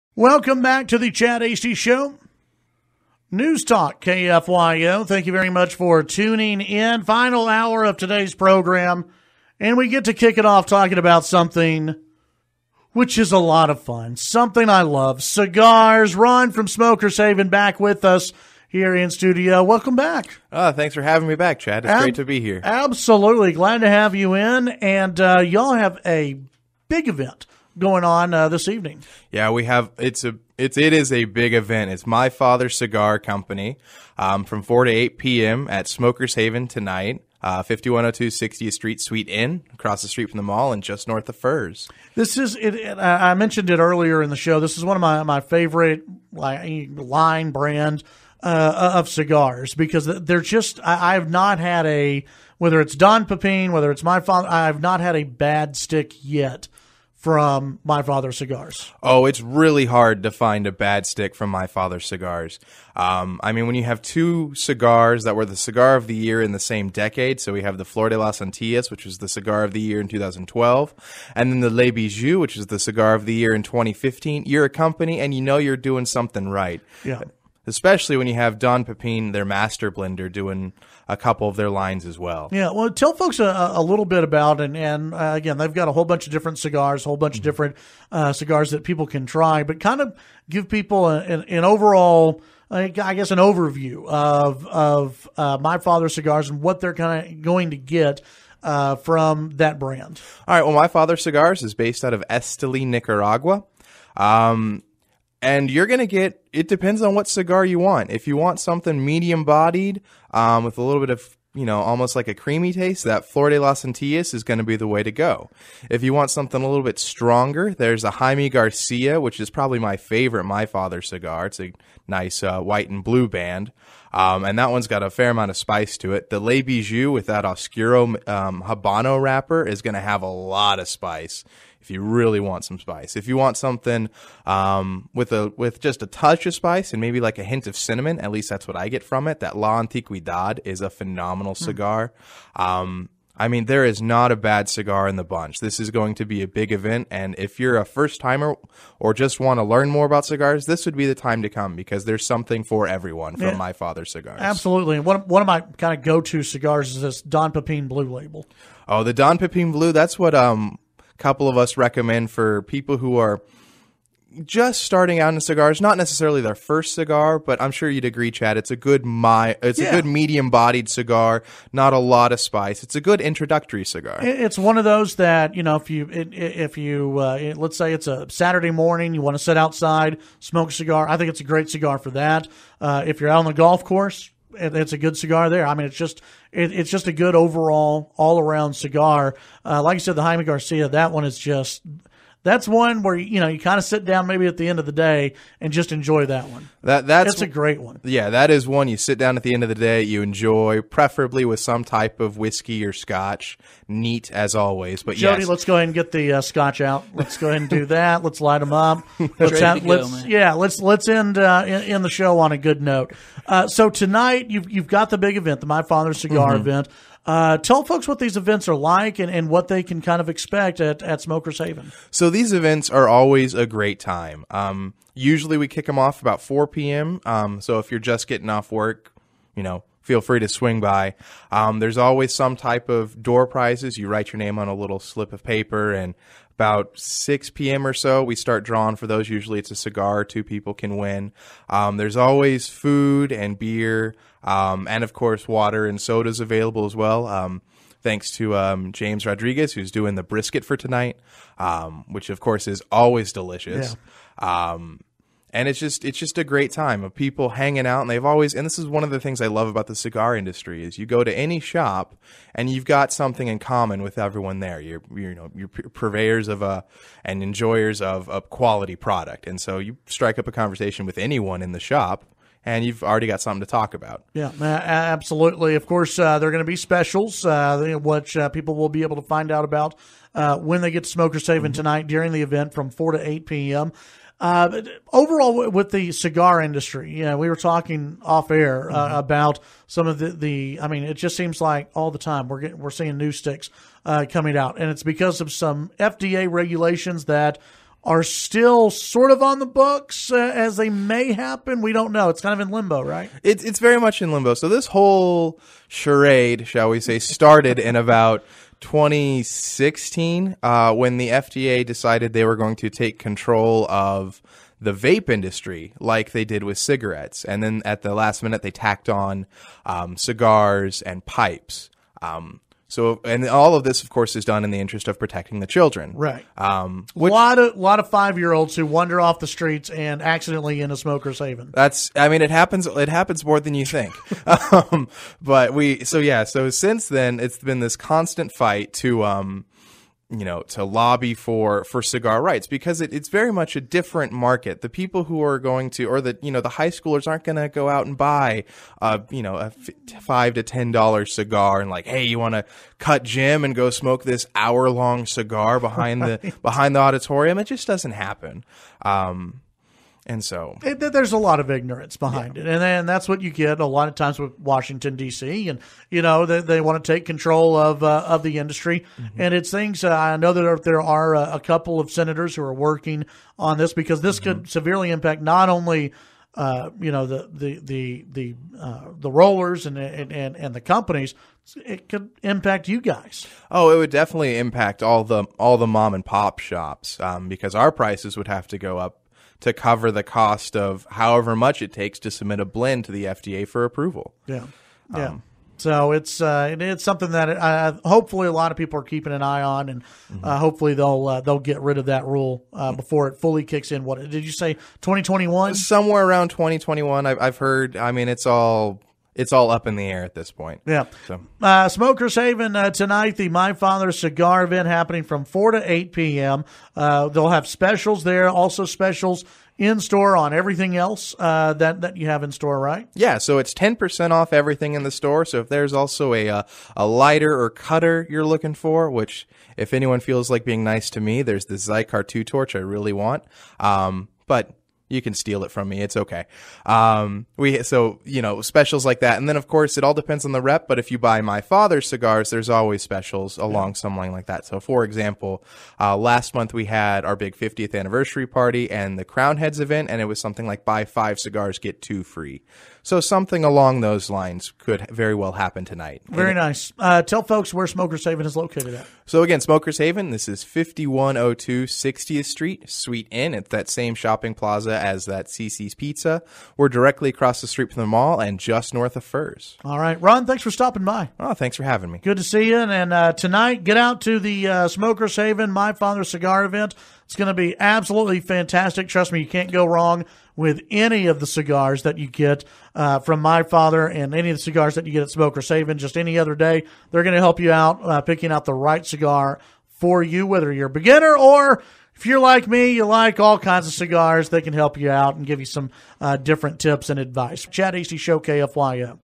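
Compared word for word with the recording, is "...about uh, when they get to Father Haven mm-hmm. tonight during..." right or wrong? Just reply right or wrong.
wrong.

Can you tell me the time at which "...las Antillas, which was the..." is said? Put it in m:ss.
1:08.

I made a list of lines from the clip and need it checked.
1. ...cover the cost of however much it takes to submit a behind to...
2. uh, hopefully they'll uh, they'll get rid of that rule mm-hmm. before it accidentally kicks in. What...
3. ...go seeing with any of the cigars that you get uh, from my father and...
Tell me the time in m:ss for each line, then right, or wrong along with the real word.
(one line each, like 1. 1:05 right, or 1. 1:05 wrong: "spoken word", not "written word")
1. 6:29 wrong: "blend", not "behind"
2. 6:40 wrong: "fully", not "accidentally"
3. 7:59 wrong: "wrong", not "seeing".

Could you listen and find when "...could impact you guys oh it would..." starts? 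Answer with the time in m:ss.
6:22.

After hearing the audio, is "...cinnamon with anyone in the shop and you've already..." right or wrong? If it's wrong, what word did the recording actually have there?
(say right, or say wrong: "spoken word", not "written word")
wrong: "conversation", not "cinnamon".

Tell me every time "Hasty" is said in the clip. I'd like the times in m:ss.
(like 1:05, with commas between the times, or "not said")
0:01, 8:17.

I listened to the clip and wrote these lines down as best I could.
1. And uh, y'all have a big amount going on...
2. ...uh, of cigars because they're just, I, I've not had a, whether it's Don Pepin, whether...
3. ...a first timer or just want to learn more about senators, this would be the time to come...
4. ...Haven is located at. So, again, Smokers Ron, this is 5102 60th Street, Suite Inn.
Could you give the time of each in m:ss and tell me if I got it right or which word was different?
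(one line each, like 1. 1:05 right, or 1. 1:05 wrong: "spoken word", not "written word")
1. 0:24 wrong: "event", not "amount"
2. 0:48 right
3. 2:27 wrong: "cigars", not "senators"
4. 7:38 wrong: "Haven", not "Ron".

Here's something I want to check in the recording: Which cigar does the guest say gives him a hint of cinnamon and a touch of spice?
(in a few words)
La Antigüedad.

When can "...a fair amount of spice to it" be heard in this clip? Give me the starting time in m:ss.
2:05.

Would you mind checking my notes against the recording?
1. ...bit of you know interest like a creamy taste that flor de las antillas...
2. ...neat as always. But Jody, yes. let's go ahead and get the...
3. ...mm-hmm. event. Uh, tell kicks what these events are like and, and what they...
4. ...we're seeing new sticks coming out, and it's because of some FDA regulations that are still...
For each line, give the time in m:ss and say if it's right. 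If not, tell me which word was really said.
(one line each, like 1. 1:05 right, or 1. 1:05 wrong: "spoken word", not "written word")
1. 1:51 wrong: "almost", not "interest"
2. 3:23 right
3. 3:36 wrong: "folks", not "kicks"
4. 4:52 right.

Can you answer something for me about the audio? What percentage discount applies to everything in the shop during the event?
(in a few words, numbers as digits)
10%.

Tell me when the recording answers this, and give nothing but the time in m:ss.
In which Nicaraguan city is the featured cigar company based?
1:42.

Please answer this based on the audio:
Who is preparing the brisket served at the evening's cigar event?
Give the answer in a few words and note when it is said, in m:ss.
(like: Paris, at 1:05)
James Rodriguez, at 4:08.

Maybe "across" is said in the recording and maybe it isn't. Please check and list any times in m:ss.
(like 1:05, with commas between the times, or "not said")
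0:39, 7:47.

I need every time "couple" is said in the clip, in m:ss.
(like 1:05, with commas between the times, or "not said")
1:21, 2:41, 6:11.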